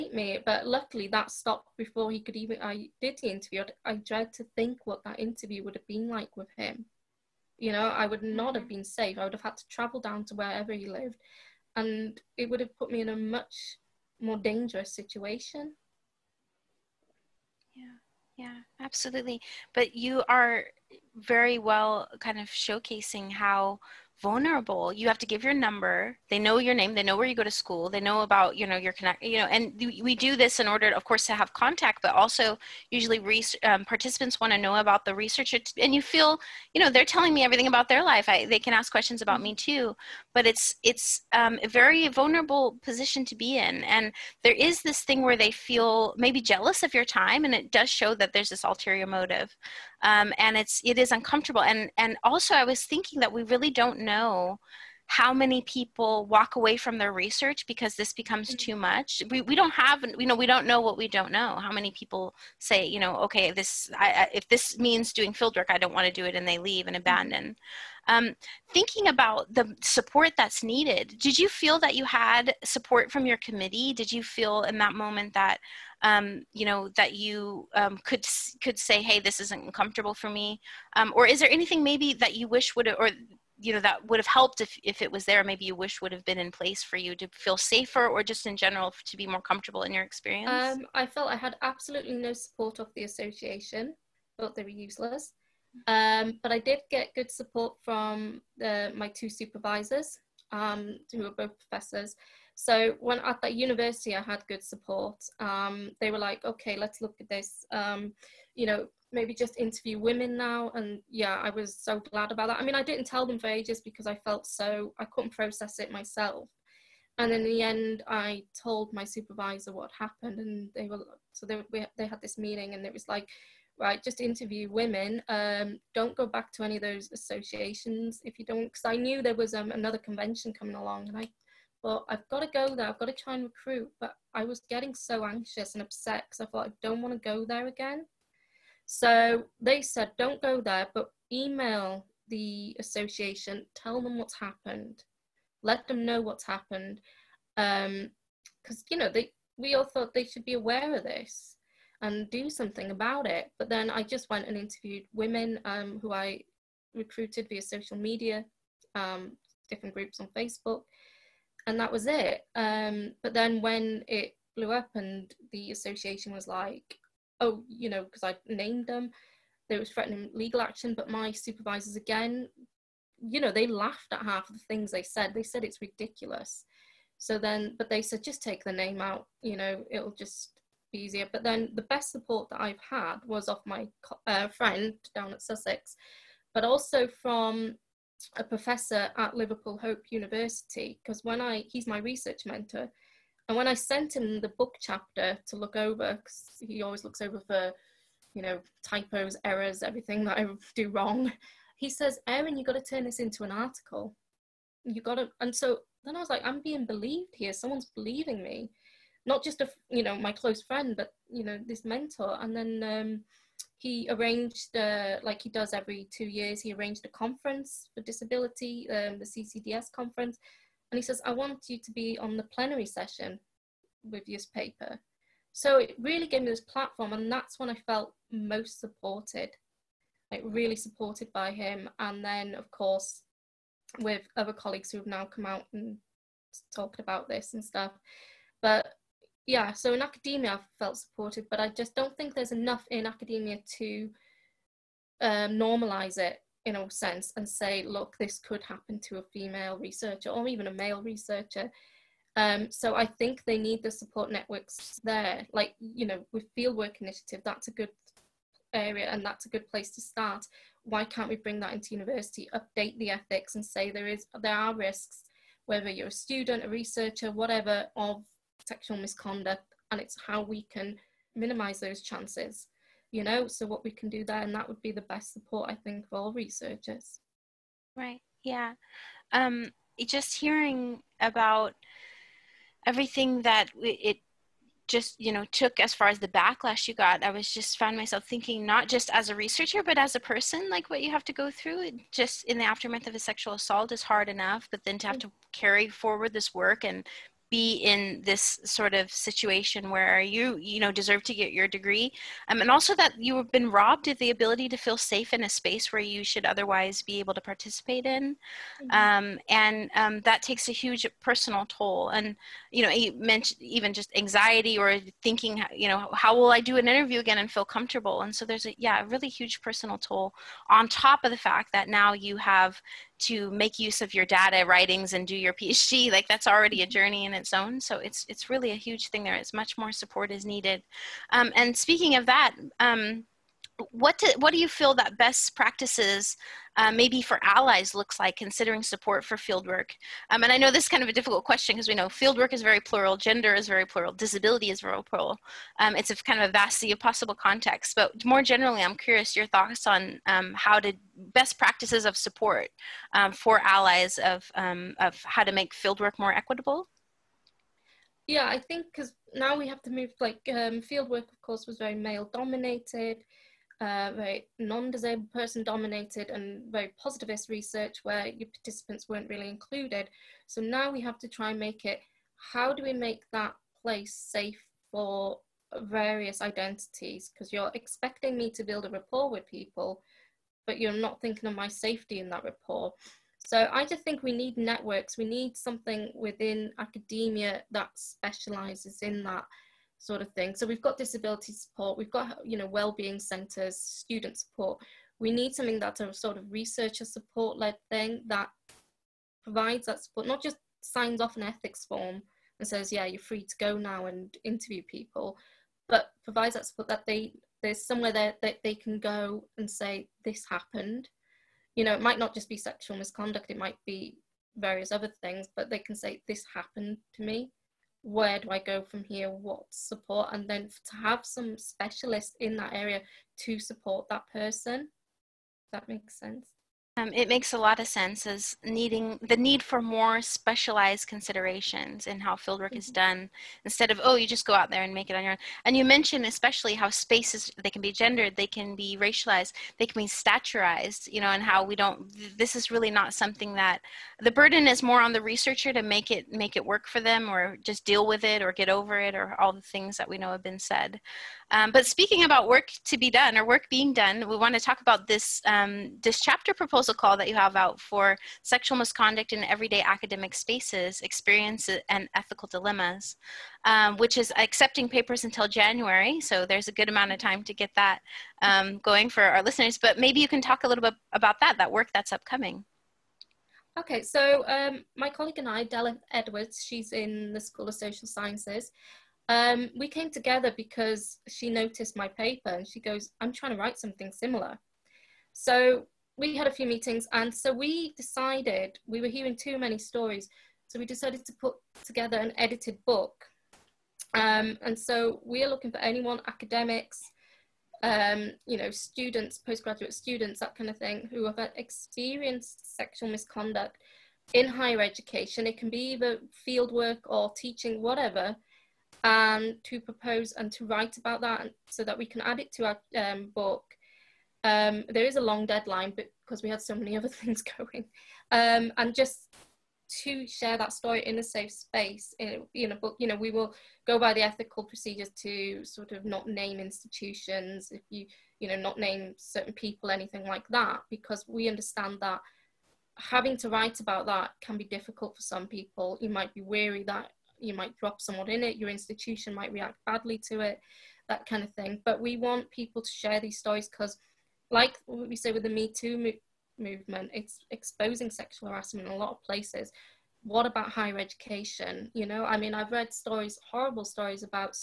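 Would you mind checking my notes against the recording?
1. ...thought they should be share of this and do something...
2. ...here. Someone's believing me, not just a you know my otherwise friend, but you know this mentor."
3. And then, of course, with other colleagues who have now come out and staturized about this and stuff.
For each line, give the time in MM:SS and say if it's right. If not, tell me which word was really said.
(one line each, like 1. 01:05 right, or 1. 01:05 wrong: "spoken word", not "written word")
1. 02:29 wrong: "aware", not "share"
2. 03:27 wrong: "close", not "otherwise"
3. 03:51 wrong: "talked", not "staturized".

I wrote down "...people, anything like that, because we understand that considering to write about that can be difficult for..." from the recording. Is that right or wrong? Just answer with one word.
wrong.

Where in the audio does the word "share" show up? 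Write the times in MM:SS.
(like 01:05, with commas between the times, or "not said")
08:40, 09:02.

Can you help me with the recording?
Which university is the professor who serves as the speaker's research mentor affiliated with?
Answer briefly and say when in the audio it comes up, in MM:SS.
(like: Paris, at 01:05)
Liverpool Hope University, at 03:09.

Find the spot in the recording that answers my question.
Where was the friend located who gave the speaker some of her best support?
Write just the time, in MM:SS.
03:05.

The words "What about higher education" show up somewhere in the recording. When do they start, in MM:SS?
09:10.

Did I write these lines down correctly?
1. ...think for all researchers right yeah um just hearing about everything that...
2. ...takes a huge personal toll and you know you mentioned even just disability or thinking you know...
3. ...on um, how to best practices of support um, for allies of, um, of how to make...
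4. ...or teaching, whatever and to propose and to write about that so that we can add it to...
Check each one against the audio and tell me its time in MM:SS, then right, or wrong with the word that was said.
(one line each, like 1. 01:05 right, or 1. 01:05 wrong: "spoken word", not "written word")
1. 04:35 right
2. 05:10 wrong: "anxiety", not "disability"
3. 05:49 right
4. 08:27 right.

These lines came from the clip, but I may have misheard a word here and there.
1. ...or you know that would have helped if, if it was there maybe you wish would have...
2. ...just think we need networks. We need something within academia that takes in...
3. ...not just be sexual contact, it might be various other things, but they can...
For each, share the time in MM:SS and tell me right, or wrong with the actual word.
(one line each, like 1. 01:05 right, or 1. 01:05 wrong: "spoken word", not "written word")
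1. 01:22 right
2. 06:23 wrong: "specializes", not "takes"
3. 06:52 wrong: "misconduct", not "contact".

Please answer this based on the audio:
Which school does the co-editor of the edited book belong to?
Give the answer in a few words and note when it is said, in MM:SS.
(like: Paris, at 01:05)
School of Social Sciences, at 07:57.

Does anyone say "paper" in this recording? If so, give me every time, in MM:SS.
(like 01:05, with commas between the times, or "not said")
03:44, 07:44, 08:02.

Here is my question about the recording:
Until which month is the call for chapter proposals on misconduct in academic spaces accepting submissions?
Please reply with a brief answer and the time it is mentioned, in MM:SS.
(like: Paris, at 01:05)
January, at 07:45.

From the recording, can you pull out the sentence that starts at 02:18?
So they said, don't go there, but email the association, tell them what's happened, let them know what's happened.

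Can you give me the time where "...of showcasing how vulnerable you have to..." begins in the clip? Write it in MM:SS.
00:22.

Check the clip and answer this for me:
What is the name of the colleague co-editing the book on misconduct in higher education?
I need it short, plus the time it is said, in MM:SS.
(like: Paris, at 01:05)
Della Edwards, at 07:55.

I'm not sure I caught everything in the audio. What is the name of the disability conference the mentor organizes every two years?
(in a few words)
CCDS conference.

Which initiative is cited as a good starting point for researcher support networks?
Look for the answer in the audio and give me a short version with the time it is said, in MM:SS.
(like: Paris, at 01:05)
Fieldwork Initiative, at 04:16.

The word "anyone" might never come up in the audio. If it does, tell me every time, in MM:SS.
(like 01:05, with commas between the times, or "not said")
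08:15.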